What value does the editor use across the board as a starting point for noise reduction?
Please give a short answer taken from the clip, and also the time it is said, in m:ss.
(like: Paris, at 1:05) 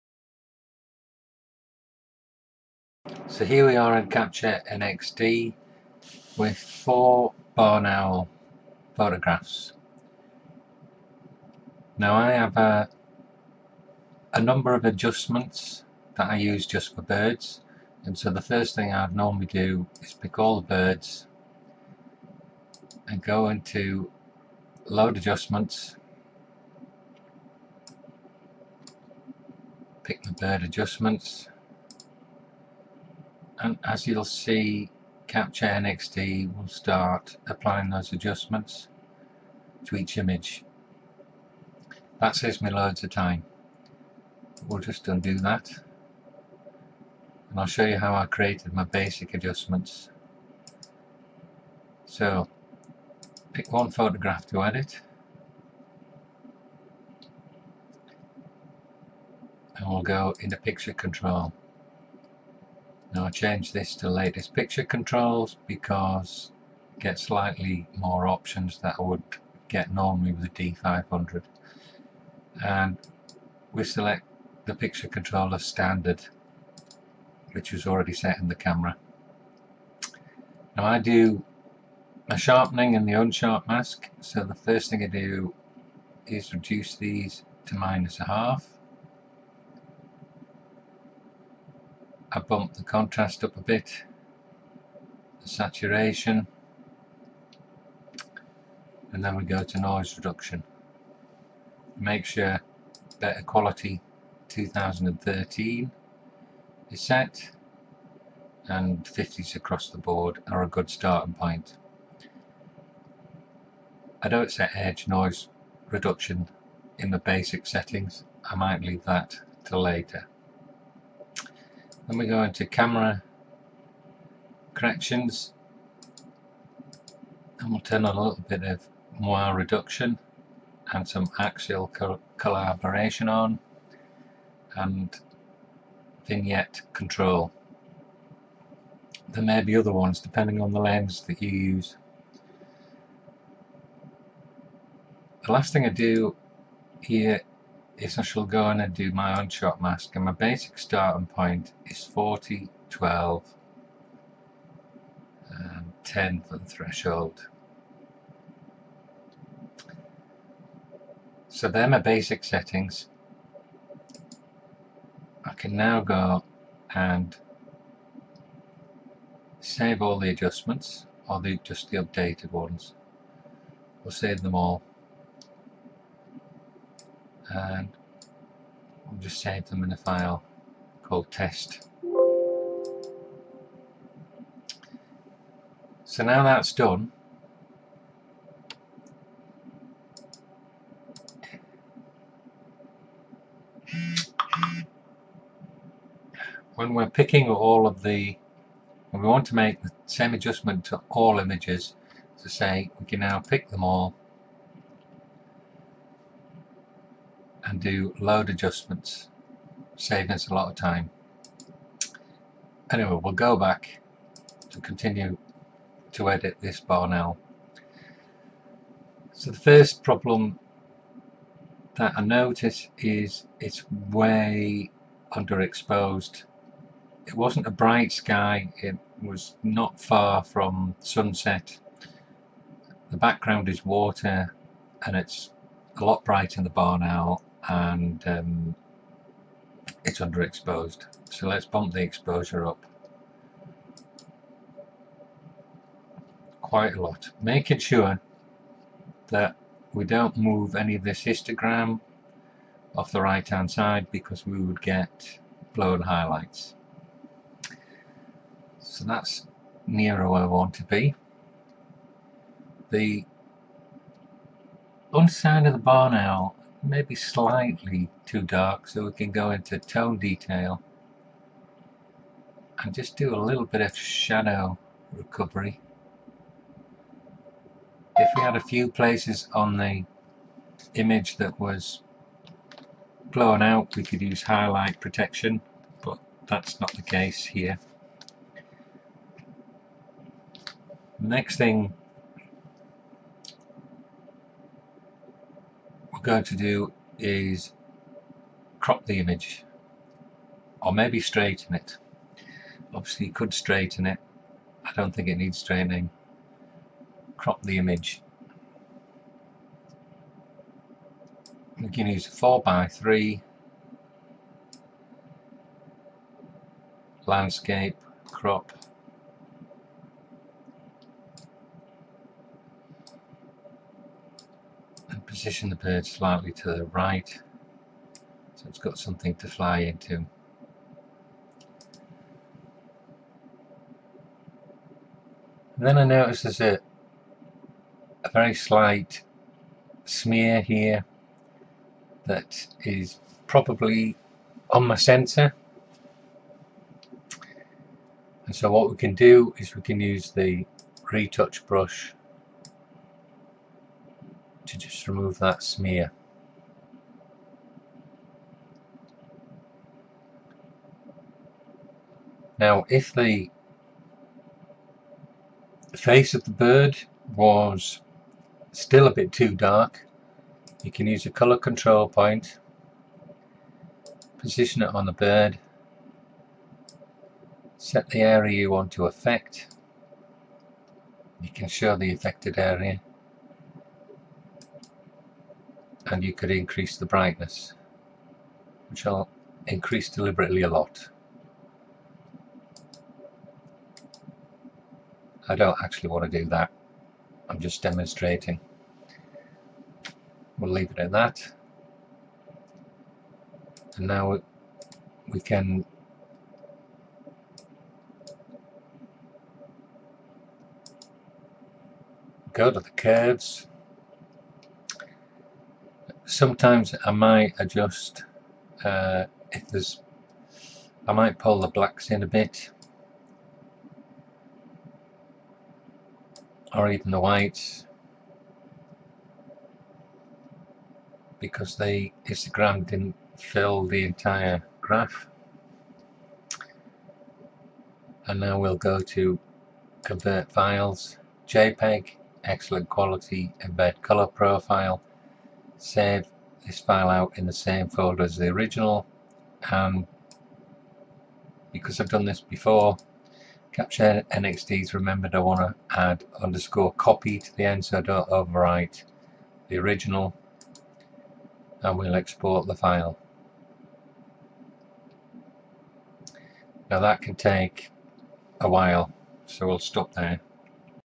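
50, at 1:49.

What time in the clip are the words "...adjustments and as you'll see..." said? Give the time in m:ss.
0:30.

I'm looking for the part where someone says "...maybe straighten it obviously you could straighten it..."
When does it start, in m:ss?
5:00.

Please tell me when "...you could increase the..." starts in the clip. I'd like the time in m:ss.
6:26.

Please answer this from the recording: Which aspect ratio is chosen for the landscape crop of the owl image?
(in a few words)
4x3.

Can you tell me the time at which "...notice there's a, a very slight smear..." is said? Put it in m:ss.
5:36.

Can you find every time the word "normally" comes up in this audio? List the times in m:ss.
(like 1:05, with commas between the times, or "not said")
0:19, 1:09.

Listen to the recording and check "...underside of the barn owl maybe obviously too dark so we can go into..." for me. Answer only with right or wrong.
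wrong.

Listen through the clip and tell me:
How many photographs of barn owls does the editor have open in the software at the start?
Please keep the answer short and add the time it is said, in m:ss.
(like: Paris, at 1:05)
4, at 0:06.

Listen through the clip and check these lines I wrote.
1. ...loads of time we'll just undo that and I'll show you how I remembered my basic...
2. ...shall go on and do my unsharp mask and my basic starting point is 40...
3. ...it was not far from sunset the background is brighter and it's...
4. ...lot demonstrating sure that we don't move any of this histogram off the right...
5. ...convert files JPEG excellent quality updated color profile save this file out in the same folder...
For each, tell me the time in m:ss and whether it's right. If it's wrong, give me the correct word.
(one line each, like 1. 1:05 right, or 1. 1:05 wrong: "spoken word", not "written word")
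1. 0:42 wrong: "created", not "remembered"
2. 2:28 right
3. 3:48 wrong: "water", not "brighter"
4. 4:07 wrong: "making", not "demonstrating"
5. 7:20 wrong: "embed", not "updated".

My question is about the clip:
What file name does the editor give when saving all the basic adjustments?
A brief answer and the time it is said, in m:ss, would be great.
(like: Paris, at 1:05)
test, at 3:01.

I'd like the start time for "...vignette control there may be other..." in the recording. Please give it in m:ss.
2:16.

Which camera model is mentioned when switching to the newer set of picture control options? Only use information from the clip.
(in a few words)
D500.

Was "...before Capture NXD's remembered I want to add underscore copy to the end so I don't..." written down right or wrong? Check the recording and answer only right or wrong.
right.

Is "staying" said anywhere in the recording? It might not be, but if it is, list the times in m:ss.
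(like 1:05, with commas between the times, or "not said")
not said.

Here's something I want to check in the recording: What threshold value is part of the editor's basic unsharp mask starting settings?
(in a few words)
10.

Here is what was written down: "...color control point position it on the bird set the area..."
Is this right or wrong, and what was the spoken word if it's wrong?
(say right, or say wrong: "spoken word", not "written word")
right.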